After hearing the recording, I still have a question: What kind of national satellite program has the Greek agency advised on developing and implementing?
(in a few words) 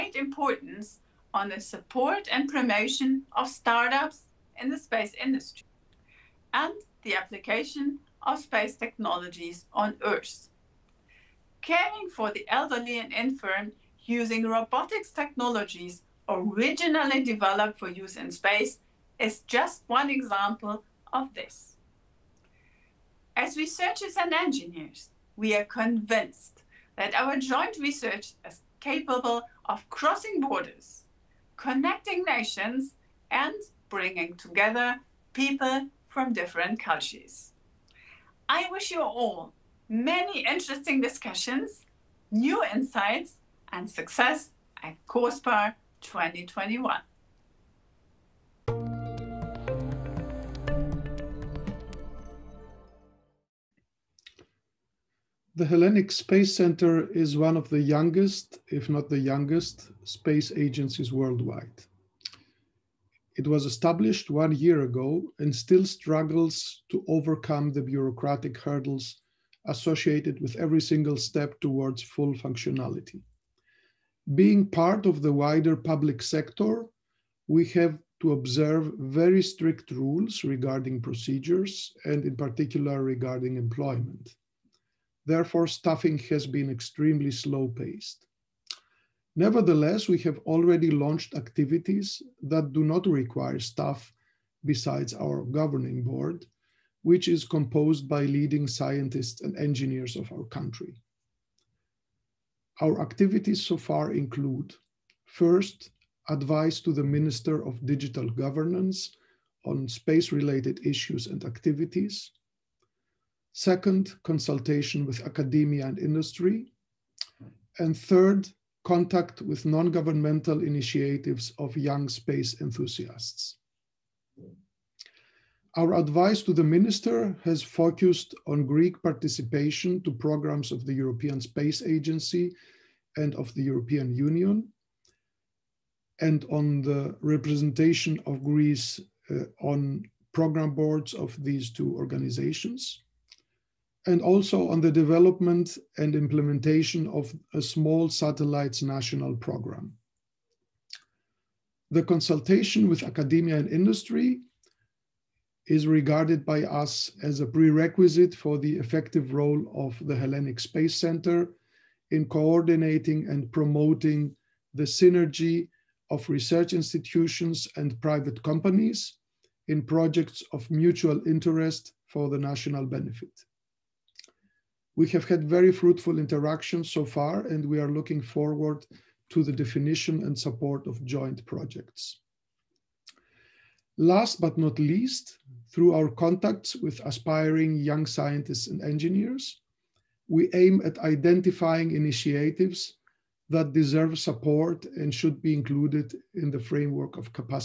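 Small satellites.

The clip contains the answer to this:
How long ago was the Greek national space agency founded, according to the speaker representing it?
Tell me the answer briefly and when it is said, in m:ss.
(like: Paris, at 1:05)
One year ago, at 1:04.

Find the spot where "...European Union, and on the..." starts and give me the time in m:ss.
2:13.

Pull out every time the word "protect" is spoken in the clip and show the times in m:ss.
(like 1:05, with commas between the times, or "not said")
not said.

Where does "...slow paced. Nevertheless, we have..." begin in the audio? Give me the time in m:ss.
1:27.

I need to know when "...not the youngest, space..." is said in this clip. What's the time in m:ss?
0:58.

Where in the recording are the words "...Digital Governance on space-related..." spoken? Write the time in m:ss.
1:47.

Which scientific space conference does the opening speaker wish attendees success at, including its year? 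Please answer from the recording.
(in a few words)
COSPAR 2021.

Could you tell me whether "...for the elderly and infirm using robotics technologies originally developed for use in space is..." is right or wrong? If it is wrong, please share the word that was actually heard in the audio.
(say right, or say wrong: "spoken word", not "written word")
right.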